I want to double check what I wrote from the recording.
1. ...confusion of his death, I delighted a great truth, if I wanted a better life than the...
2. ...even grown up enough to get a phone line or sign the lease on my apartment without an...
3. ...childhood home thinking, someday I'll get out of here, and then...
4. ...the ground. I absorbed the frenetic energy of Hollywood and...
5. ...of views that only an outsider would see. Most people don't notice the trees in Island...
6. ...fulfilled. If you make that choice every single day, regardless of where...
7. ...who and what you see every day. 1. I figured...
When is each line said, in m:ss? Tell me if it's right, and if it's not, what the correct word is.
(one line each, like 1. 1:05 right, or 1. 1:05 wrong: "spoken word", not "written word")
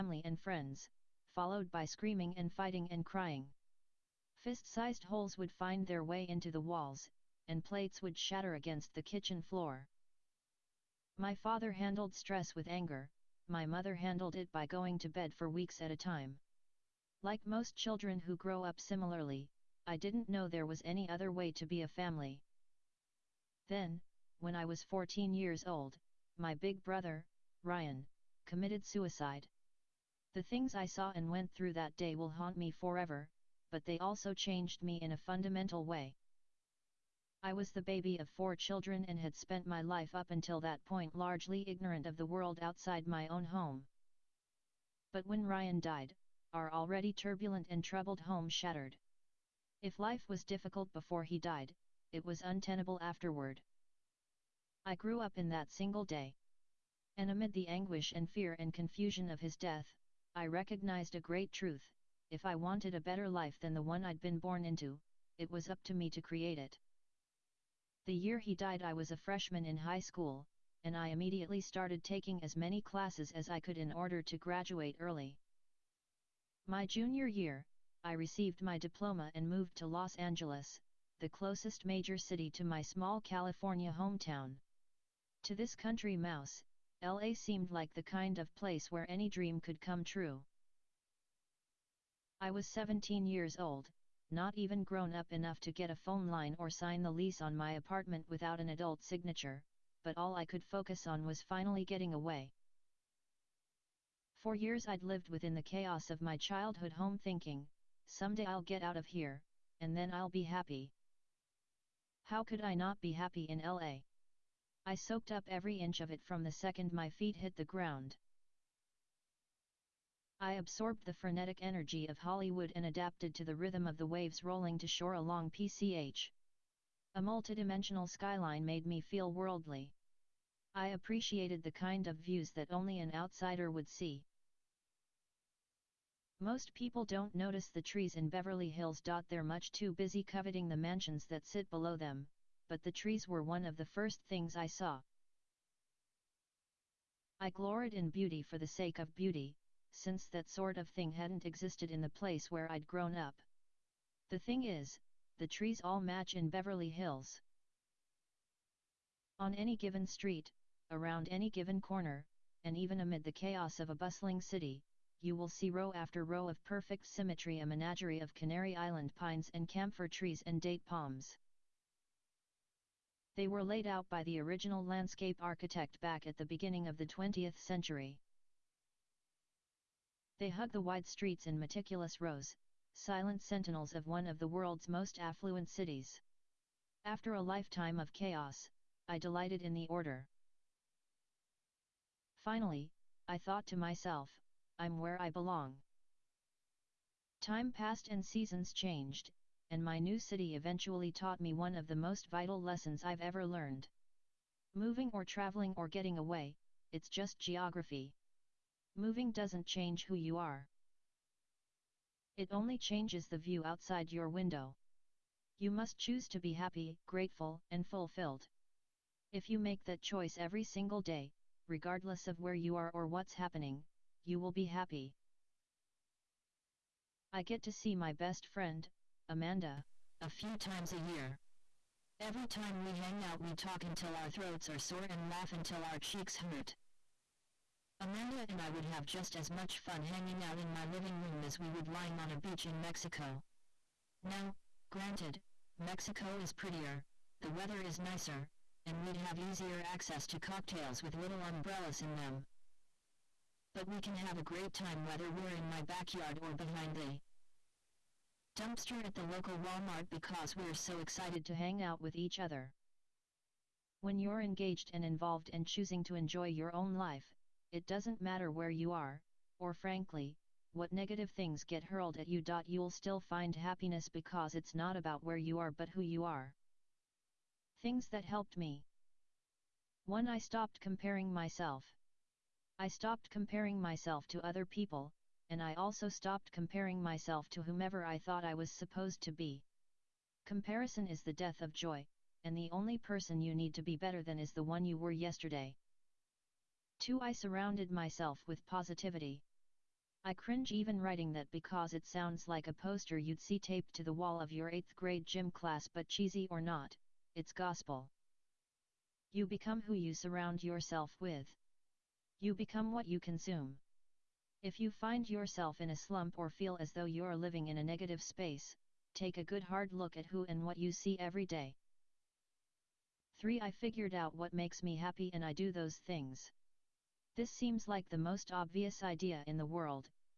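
1. 0:58 wrong: "recognized", not "delighted"
2. 1:34 right
3. 1:46 right
4. 1:57 right
5. 2:12 wrong: "Beverly", not "Island"
6. 3:37 right
7. 5:20 wrong: "3", not "1".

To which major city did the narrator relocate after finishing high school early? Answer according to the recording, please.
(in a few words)
Los Angeles.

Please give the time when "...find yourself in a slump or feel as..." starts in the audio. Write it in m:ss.
5:14.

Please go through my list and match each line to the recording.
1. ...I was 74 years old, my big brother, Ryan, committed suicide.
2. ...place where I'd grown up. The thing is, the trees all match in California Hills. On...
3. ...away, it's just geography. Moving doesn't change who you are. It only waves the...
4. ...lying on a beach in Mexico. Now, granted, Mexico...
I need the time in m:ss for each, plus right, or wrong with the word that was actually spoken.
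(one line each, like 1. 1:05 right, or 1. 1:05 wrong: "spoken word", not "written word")
1. 0:24 wrong: "14", not "74"
2. 2:32 wrong: "Beverly", not "California"
3. 3:26 wrong: "changes", not "waves"
4. 4:01 right.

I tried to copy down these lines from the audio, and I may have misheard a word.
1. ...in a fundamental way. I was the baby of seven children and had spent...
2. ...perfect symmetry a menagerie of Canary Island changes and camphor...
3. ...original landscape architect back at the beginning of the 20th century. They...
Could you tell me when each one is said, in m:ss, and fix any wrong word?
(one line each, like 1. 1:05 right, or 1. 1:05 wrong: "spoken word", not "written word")
1. 0:34 wrong: "four", not "seven"
2. 2:46 wrong: "pines", not "changes"
3. 2:54 right.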